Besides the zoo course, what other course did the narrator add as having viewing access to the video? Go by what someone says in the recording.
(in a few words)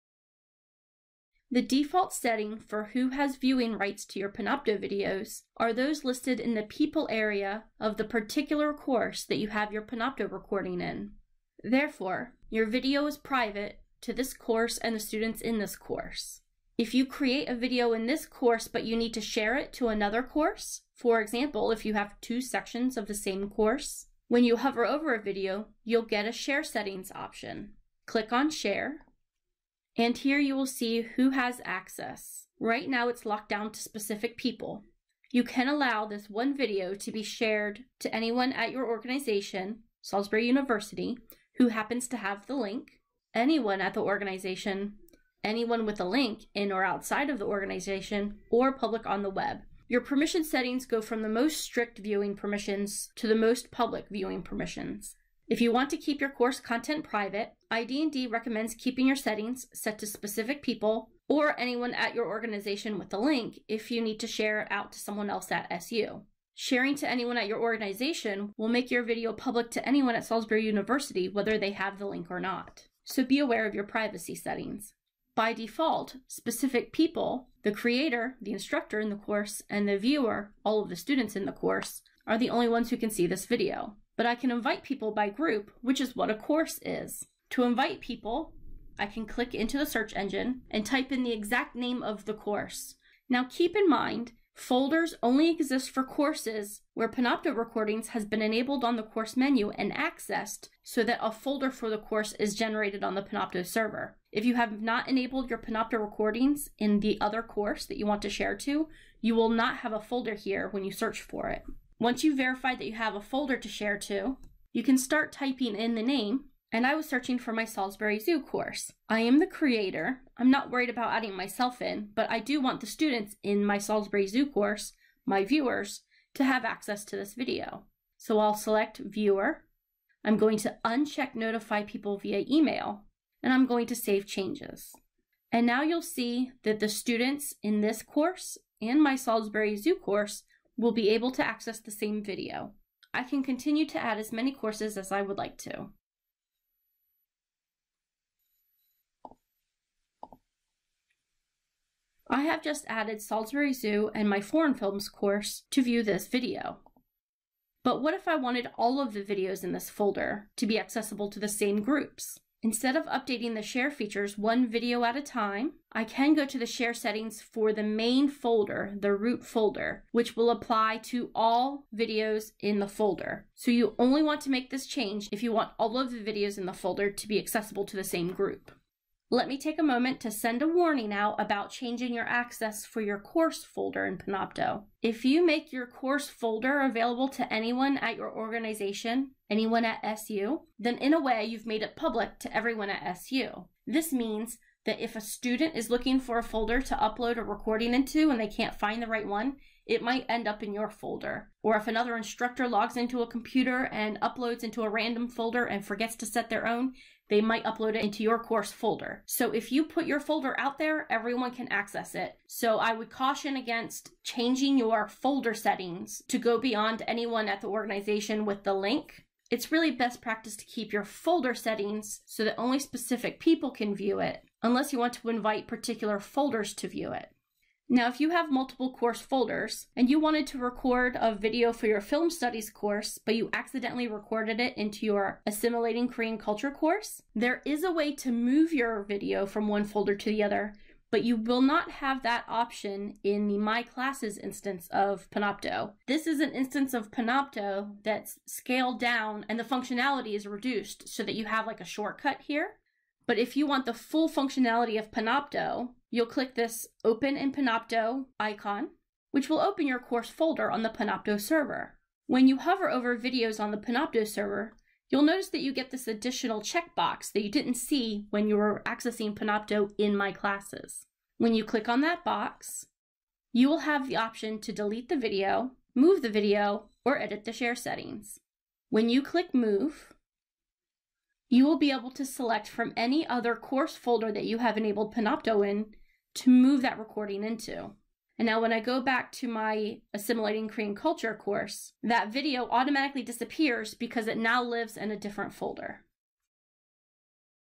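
foreign films course.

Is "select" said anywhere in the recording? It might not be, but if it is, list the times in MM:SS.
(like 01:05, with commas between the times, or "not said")
02:08, 04:42.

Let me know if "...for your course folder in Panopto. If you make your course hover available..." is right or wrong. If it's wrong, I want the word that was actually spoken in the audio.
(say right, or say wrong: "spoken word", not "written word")
wrong: "folder", not "hover".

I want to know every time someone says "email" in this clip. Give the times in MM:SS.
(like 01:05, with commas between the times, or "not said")
02:12.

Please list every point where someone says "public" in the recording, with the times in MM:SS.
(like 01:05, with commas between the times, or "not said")
00:48, 00:53, 01:09, 03:11.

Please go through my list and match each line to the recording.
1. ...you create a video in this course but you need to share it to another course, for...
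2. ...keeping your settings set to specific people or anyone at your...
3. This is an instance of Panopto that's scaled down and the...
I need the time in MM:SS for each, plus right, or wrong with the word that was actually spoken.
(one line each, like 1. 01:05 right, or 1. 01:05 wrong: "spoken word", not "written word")
1. 00:16 right
2. 00:58 right
3. 04:06 right.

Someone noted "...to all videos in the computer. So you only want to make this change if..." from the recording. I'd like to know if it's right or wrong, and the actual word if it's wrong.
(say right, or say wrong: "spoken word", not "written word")
wrong: "folder", not "computer".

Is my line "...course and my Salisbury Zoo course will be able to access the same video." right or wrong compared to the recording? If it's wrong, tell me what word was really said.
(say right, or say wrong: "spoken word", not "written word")
right.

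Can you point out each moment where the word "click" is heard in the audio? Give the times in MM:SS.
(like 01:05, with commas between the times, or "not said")
00:28, 01:29, 04:16, 04:31, 04:39.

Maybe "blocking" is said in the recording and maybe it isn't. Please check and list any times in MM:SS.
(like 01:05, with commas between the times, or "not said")
not said.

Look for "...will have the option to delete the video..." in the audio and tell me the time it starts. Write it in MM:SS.
04:33.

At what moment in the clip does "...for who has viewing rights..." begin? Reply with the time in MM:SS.
00:02.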